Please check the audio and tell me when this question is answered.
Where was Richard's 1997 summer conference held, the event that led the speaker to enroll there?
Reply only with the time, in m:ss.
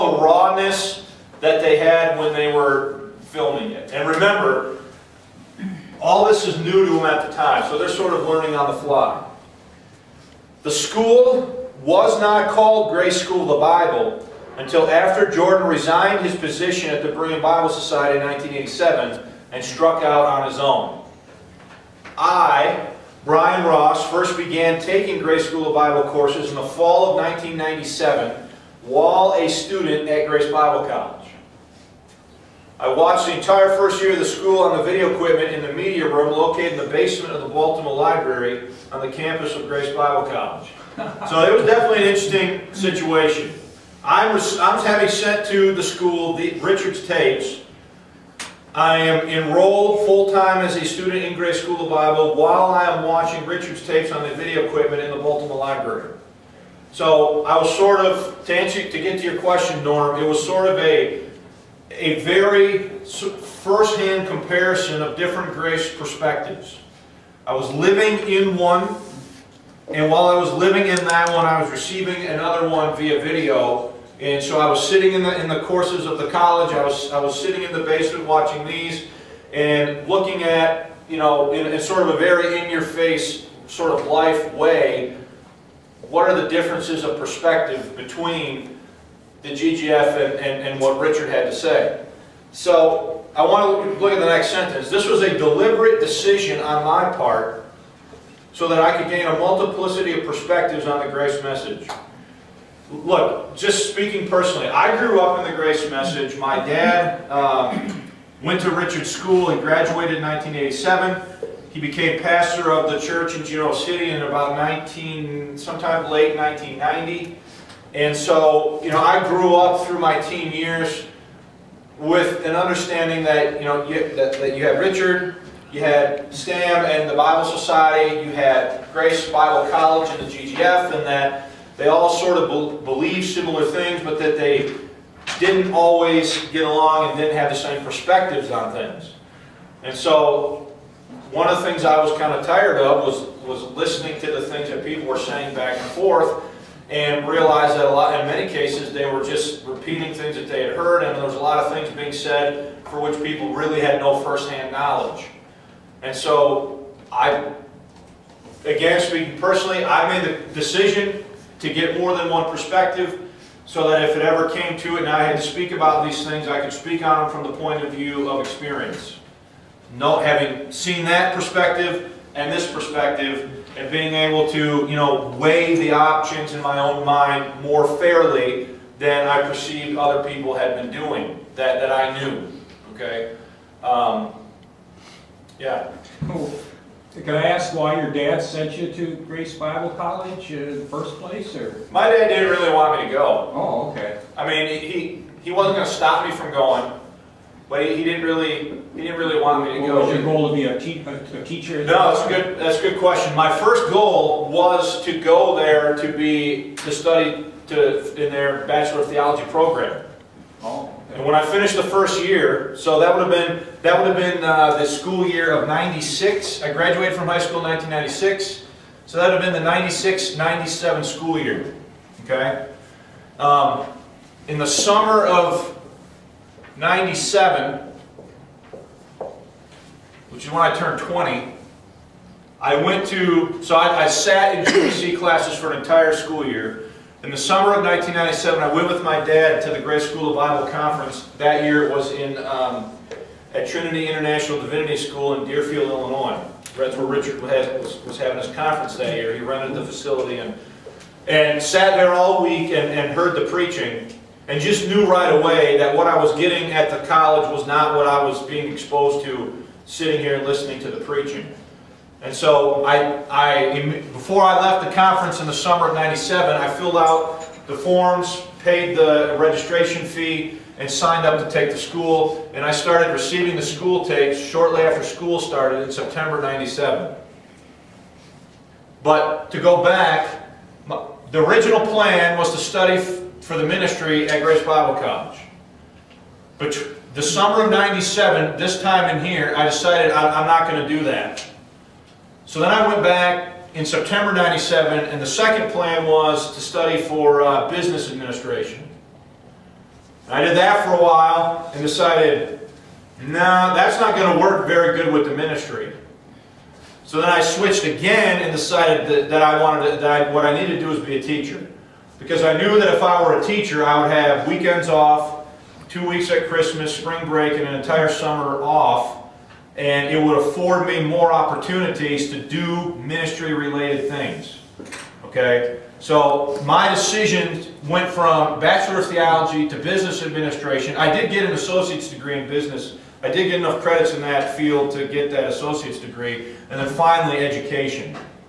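4:03.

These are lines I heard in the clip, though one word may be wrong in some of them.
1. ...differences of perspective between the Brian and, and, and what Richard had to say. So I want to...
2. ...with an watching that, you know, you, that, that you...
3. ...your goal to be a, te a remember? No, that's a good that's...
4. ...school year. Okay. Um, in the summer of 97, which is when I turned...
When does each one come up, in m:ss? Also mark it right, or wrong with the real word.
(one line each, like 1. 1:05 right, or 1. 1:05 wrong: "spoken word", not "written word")
1. 1:26 wrong: "GGF", not "Brian"
2. 2:01 wrong: "understanding", not "watching"
3. 3:20 wrong: "teacher", not "remember"
4. 3:41 right.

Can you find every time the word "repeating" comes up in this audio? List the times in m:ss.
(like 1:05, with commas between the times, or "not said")
2:29.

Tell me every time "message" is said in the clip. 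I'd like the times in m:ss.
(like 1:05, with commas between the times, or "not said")
1:41, 1:45.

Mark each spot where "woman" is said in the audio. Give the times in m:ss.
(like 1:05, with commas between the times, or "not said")
not said.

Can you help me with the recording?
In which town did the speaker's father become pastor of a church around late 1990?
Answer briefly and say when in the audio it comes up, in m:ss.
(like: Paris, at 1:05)
Genoa City, at 1:53.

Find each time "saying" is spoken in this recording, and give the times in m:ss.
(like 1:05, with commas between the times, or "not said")
2:25.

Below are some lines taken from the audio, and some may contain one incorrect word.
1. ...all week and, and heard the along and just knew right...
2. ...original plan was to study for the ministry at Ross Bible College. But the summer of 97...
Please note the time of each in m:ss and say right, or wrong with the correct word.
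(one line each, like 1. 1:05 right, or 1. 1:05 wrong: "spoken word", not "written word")
1. 4:12 wrong: "preaching", not "along"
2. 4:41 wrong: "Grace", not "Ross".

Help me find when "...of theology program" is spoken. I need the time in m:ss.
3:29.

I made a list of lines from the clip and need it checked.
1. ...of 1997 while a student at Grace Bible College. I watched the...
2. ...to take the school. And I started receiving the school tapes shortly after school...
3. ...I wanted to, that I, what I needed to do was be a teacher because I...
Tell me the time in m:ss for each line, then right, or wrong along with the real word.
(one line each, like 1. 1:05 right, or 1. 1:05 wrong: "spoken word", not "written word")
1. 0:27 right
2. 4:31 right
3. 5:09 right.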